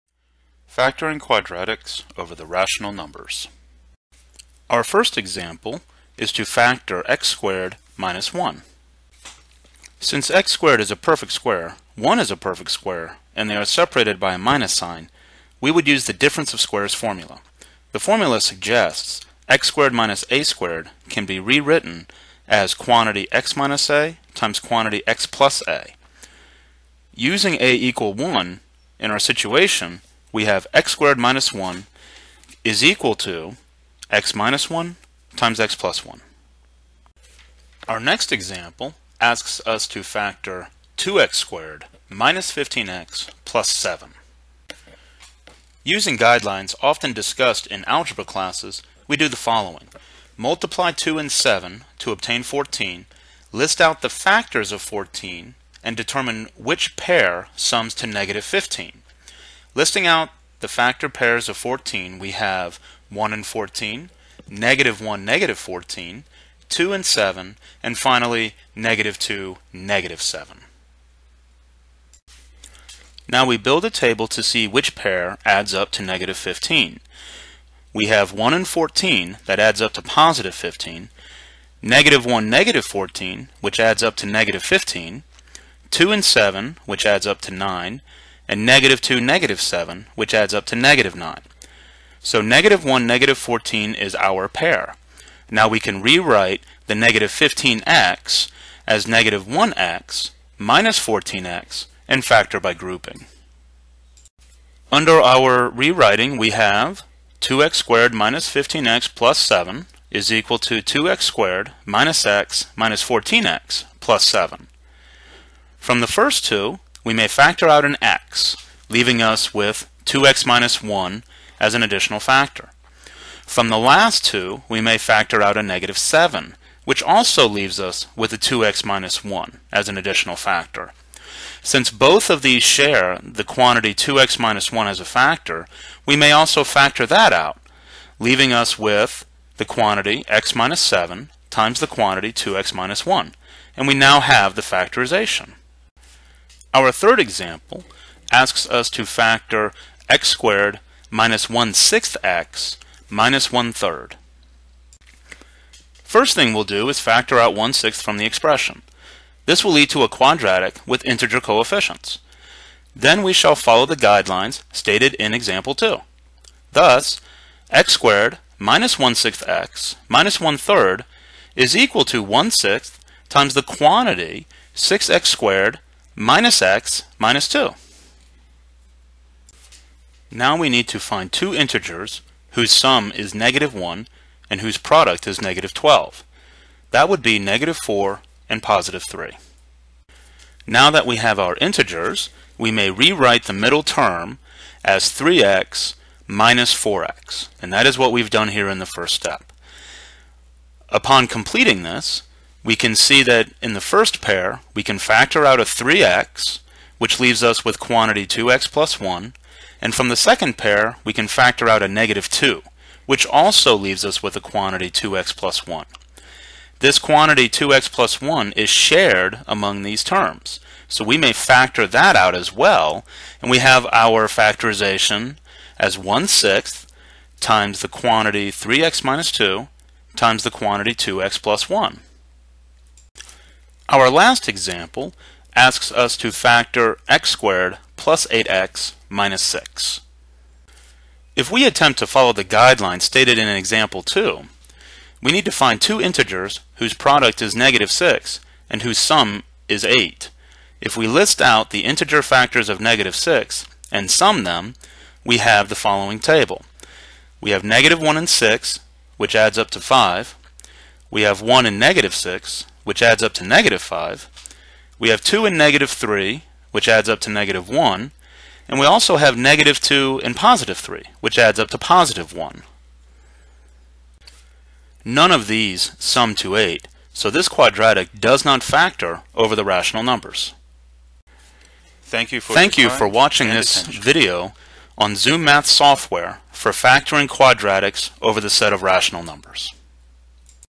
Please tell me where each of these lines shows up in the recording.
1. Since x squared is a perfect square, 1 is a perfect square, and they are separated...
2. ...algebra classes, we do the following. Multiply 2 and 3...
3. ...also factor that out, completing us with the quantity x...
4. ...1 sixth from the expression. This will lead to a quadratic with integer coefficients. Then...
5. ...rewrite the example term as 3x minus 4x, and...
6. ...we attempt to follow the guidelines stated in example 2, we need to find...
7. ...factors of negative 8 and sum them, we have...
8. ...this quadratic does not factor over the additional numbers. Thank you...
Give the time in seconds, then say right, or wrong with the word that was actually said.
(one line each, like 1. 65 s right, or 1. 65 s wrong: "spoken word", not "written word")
1. 9 s right
2. 47 s wrong: "7", not "3"
3. 136 s wrong: "leaving", not "completing"
4. 157 s right
5. 192 s wrong: "middle", not "example"
6. 241 s right
7. 252 s wrong: "6", not "8"
8. 277 s wrong: "rational", not "additional".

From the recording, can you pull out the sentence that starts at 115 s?
From the first two, we may factor out an x, leaving us with 2x minus 1 as an additional factor.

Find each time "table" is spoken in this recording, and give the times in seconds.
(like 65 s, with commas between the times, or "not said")
73 s, 256 s.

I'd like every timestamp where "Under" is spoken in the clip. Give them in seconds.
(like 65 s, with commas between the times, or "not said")
104 s.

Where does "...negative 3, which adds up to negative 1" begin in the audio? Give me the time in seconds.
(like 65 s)
265 s.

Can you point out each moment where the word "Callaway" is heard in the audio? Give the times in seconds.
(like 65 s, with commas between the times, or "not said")
not said.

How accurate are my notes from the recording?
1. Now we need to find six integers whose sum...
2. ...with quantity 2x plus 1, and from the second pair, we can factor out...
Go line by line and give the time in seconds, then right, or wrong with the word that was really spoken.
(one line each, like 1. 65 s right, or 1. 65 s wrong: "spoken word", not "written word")
1. 180 s wrong: "two", not "six"
2. 207 s right.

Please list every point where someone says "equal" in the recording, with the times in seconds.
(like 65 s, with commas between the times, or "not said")
27 s, 32 s, 110 s, 171 s.